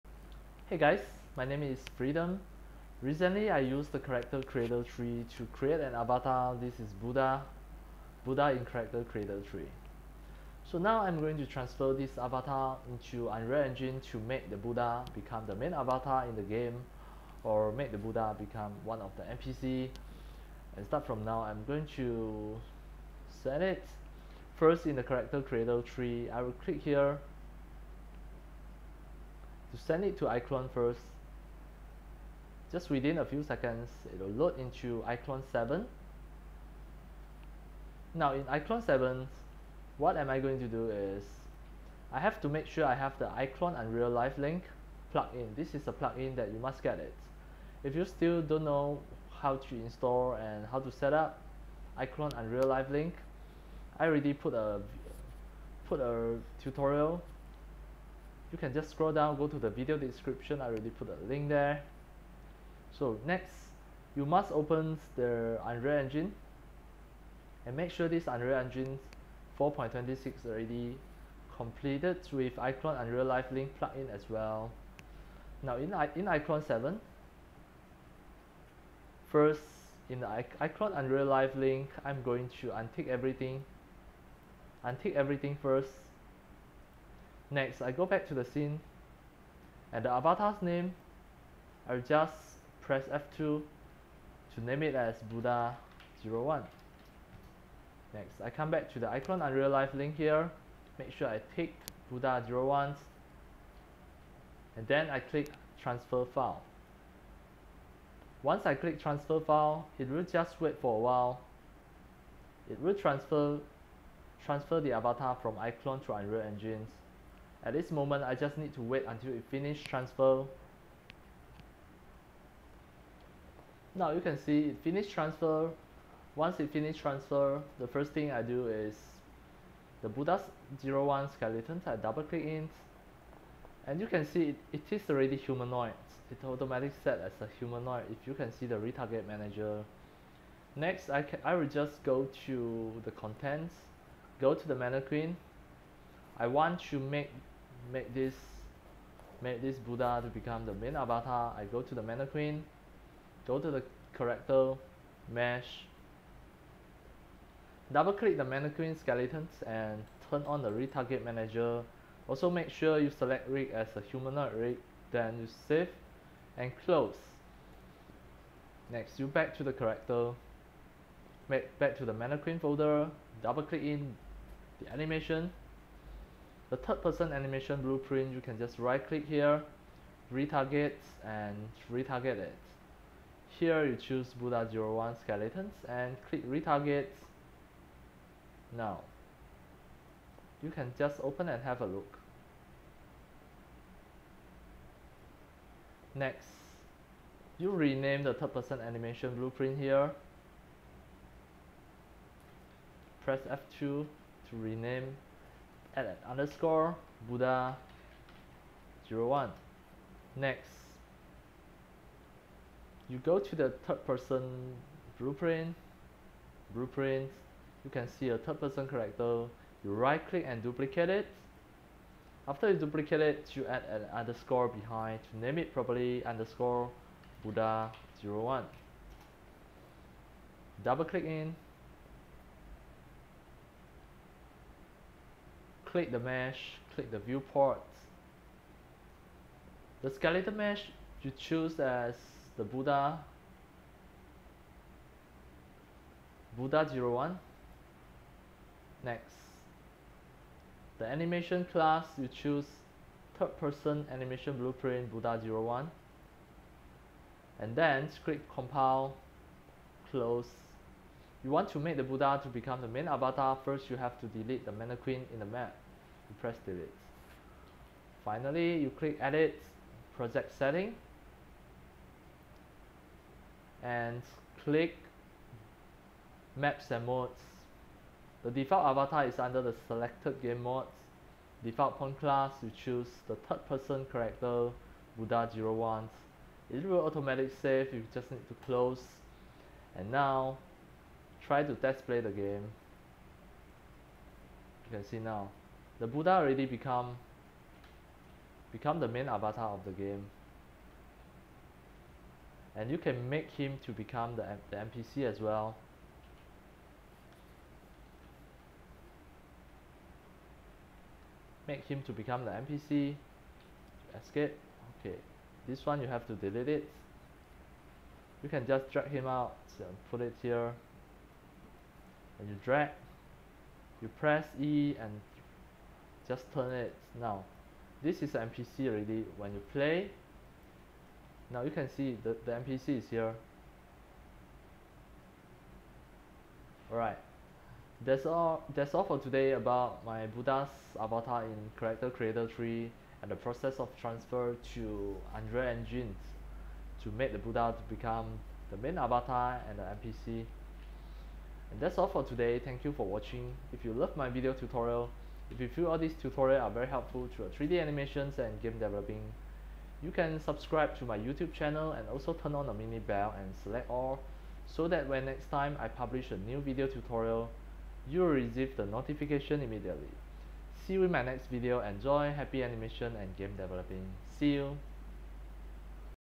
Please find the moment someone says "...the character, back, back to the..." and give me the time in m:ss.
2:49.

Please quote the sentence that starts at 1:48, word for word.
Once I click transfer file, it will just wait for a while.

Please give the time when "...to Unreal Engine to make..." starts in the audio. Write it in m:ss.
5:44.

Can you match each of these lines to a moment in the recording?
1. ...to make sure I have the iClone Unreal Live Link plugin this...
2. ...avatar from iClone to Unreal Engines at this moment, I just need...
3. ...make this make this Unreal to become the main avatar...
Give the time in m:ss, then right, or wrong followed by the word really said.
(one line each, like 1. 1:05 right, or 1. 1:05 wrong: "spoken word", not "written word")
1. 0:42 right
2. 1:54 right
3. 2:27 wrong: "Buddha", not "Unreal".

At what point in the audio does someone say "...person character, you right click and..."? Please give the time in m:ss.
3:38.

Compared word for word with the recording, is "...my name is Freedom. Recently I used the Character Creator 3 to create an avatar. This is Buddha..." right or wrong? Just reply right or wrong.
right.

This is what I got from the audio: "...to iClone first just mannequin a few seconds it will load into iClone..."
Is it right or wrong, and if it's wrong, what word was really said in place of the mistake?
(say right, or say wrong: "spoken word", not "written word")
wrong: "within", not "mannequin".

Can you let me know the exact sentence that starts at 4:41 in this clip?
Default point class, you choose the third person character, Buddha01.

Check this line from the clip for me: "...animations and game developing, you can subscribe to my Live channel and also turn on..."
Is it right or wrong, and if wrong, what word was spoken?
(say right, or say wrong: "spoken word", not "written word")
wrong: "YouTube", not "Live".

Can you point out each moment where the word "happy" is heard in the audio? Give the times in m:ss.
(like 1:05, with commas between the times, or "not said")
6:12.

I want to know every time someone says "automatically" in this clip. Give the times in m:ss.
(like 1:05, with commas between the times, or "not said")
2:16, 4:47.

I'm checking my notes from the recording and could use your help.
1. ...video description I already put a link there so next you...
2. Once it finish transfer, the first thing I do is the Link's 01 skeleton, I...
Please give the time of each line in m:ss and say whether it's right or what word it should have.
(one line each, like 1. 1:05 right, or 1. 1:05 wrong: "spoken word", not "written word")
1. 0:59 right
2. 2:06 wrong: "Buddha", not "Link".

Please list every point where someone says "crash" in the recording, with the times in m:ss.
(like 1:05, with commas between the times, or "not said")
not said.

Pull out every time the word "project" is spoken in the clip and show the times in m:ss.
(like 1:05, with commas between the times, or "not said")
4:30.